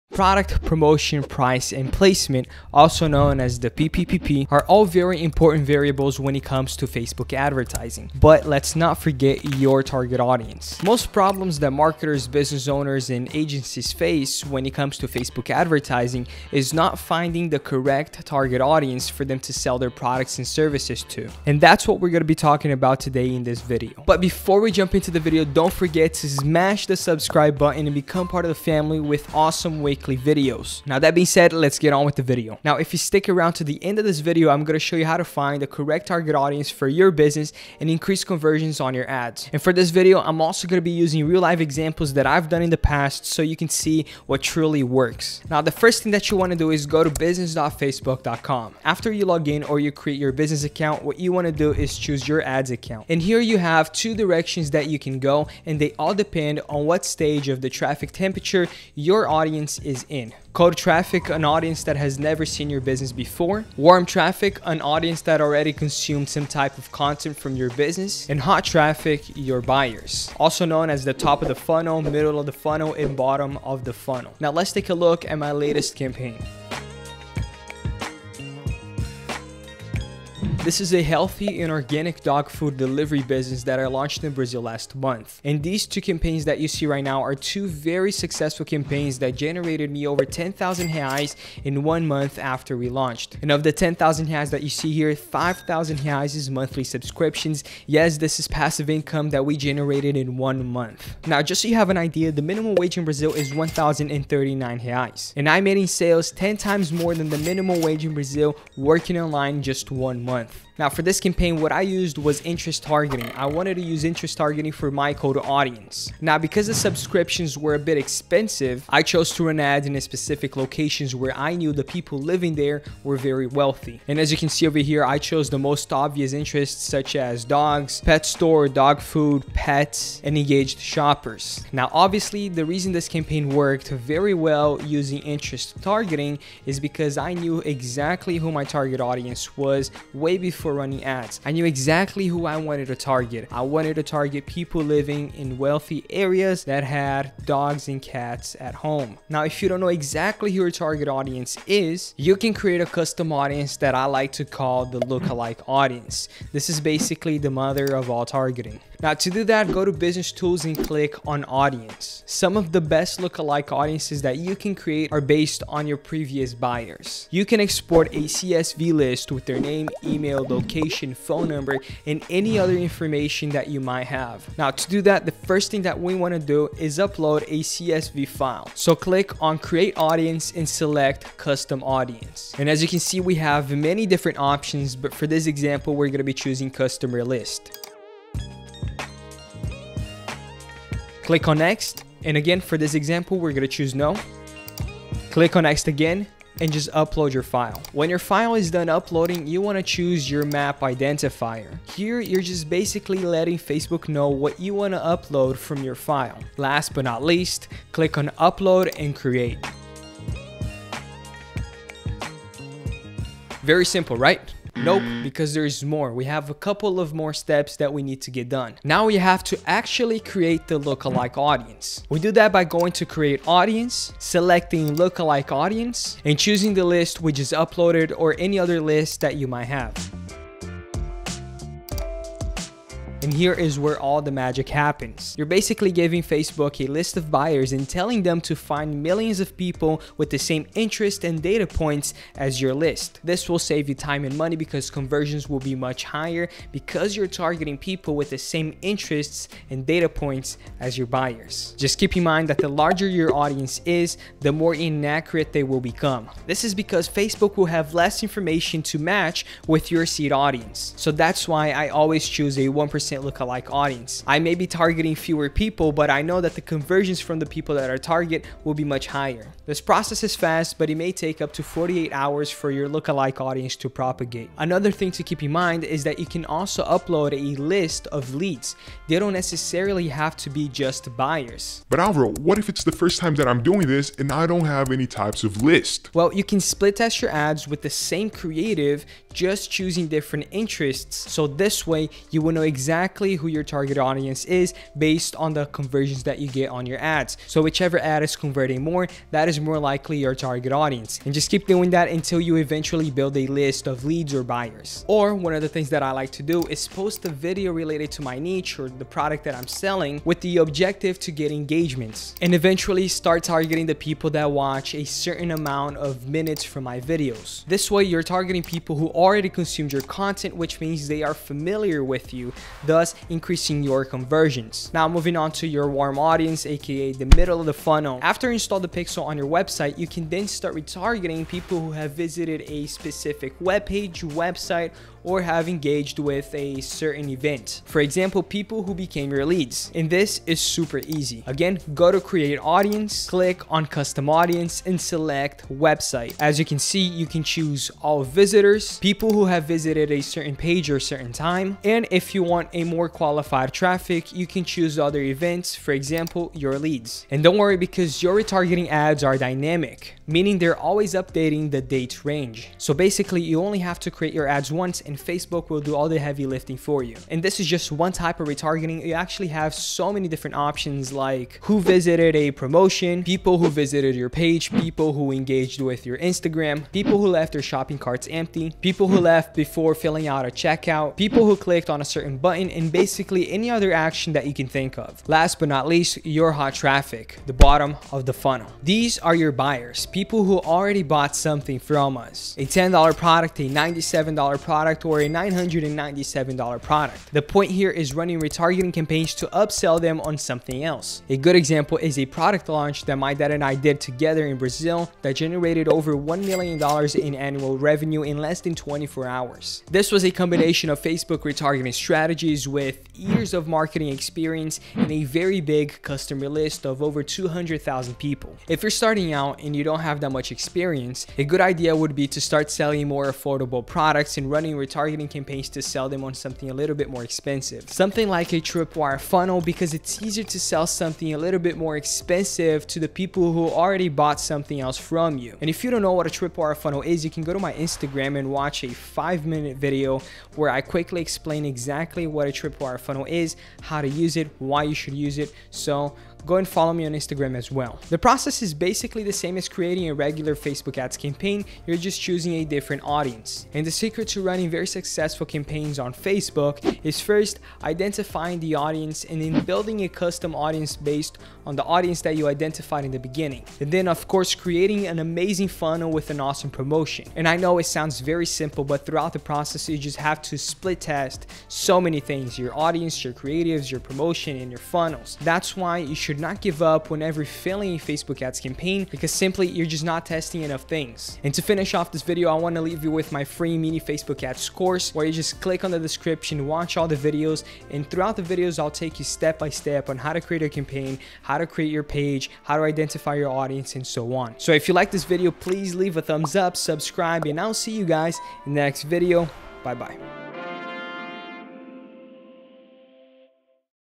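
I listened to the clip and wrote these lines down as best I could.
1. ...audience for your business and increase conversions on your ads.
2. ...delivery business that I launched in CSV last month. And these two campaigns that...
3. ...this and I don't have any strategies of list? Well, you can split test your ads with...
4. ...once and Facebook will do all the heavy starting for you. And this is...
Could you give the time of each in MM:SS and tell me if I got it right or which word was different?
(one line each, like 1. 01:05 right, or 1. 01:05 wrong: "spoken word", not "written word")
1. 00:36 right
2. 01:22 wrong: "Brazil", not "CSV"
3. 04:43 wrong: "types", not "strategies"
4. 06:04 wrong: "lifting", not "starting".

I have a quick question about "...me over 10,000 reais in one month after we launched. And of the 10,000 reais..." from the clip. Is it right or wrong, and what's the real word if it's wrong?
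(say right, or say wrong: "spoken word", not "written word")
right.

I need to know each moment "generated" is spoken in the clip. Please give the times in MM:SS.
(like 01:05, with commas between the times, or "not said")
01:29, 01:39, 06:45.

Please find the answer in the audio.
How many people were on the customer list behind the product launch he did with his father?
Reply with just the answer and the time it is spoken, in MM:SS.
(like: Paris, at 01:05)
200,000, at 06:57.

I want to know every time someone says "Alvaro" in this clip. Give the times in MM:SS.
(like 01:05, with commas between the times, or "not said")
04:41.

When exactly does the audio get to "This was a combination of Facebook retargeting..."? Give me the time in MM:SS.
06:49.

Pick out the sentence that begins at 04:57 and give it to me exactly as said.
So whichever ad is converting more, that is more likely your target audience.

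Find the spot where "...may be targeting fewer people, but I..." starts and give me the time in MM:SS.
04:24.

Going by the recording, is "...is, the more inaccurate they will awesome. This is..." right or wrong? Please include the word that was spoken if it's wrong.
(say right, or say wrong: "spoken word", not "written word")
wrong: "become", not "awesome".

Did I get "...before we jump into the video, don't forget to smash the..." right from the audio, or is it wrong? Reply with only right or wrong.
right.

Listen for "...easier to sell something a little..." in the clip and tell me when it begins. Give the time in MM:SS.
07:10.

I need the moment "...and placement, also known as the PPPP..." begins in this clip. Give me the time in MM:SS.
00:01.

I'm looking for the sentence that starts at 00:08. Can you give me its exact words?
But let's not forget your target audience.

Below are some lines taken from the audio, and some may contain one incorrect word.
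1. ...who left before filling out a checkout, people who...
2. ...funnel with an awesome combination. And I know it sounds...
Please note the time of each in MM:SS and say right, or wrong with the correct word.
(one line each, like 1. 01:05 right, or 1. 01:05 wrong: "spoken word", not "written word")
1. 06:19 right
2. 07:45 wrong: "promotion", not "combination".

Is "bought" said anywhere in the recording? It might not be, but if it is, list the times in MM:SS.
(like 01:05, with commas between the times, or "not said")
06:31, 07:14.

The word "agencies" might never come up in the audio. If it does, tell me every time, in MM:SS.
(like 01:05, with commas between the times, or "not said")
00:13.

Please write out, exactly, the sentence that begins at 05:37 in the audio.
For example, people who became your leads.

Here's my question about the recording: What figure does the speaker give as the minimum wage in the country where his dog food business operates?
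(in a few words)
1,039 reais.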